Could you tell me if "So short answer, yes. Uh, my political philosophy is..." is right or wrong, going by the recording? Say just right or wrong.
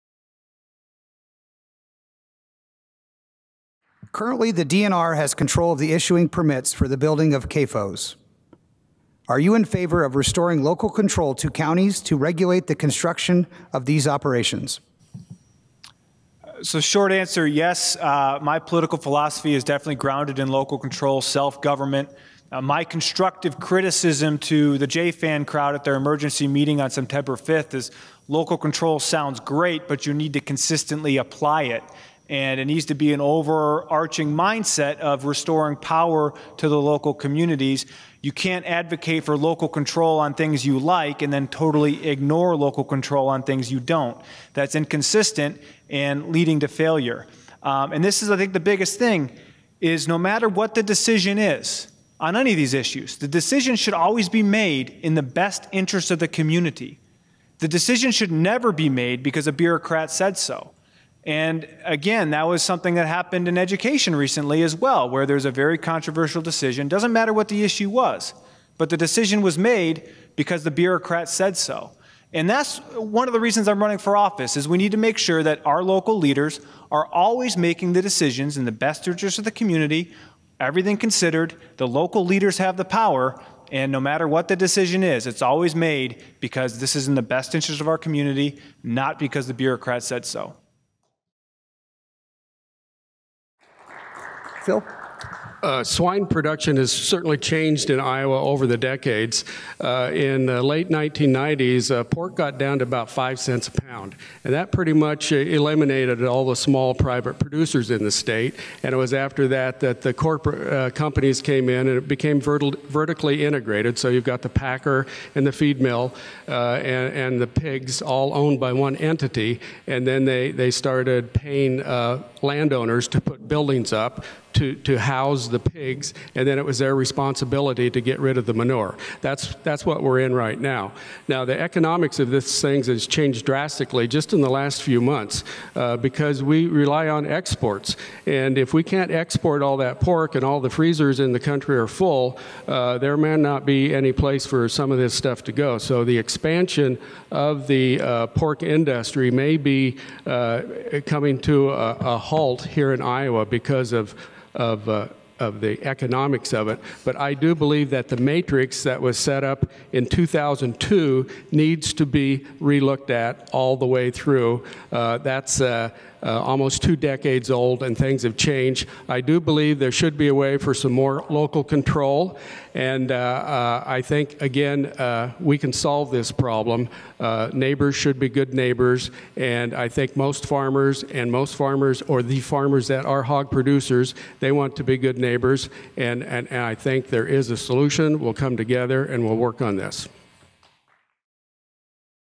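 right.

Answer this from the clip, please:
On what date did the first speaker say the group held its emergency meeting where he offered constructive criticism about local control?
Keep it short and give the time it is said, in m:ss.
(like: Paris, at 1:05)
September 5th, at 0:26.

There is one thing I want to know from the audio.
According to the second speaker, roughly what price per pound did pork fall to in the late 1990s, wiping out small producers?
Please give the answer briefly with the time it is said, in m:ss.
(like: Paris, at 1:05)
5 cents, at 1:43.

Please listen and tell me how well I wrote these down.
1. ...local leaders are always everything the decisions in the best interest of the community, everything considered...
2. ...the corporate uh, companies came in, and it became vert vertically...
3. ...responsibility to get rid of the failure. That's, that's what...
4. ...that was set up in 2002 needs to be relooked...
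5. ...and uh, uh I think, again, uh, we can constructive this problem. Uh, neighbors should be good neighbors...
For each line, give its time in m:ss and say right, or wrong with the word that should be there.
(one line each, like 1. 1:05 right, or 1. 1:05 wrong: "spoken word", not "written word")
1. 1:15 wrong: "making", not "everything"
2. 1:50 right
3. 2:06 wrong: "manure", not "failure"
4. 2:38 right
5. 2:52 wrong: "solve", not "constructive".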